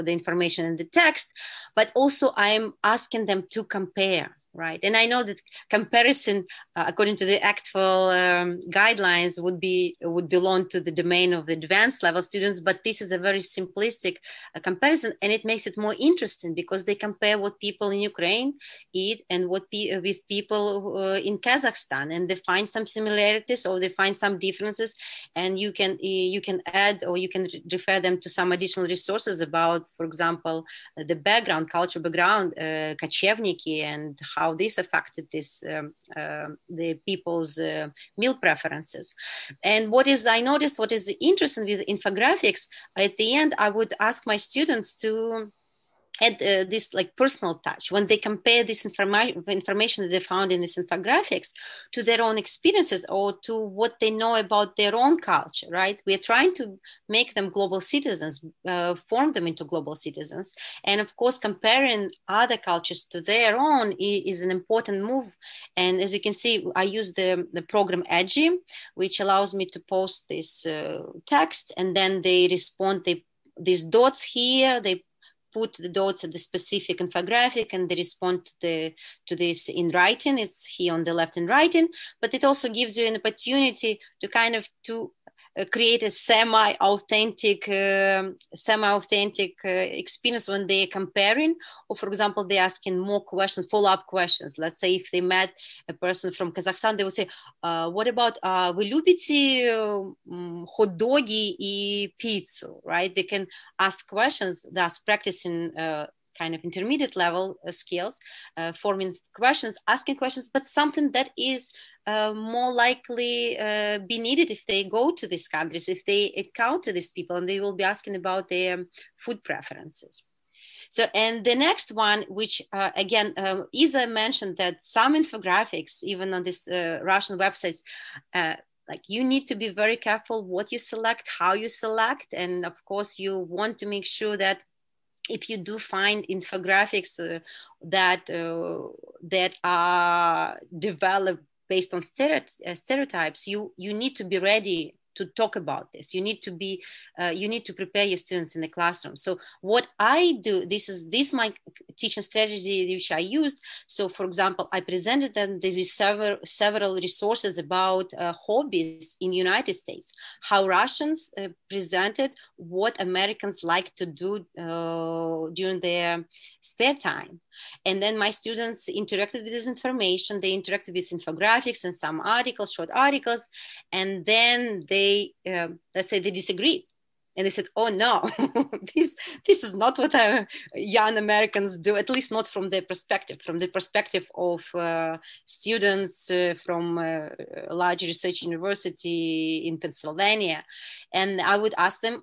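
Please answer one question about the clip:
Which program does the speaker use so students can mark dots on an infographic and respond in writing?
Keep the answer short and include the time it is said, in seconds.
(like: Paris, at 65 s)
Edji, at 68 s.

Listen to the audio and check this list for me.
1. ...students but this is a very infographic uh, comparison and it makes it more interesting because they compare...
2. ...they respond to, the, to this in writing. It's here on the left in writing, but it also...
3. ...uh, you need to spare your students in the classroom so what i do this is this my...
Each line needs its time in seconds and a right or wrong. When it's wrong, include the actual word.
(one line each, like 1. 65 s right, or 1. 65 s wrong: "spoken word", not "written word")
1. 12 s wrong: "simplistic", not "infographic"
2. 77 s right
3. 147 s wrong: "prepare", not "spare".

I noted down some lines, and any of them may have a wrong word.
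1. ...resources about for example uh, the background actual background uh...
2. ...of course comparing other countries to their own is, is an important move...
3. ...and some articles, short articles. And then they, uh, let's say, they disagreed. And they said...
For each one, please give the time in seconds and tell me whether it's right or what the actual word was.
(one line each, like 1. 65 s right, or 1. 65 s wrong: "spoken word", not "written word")
1. 28 s wrong: "cultural", not "actual"
2. 61 s wrong: "cultures", not "countries"
3. 171 s right.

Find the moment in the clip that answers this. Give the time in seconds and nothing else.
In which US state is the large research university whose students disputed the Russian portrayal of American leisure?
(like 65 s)
189 s.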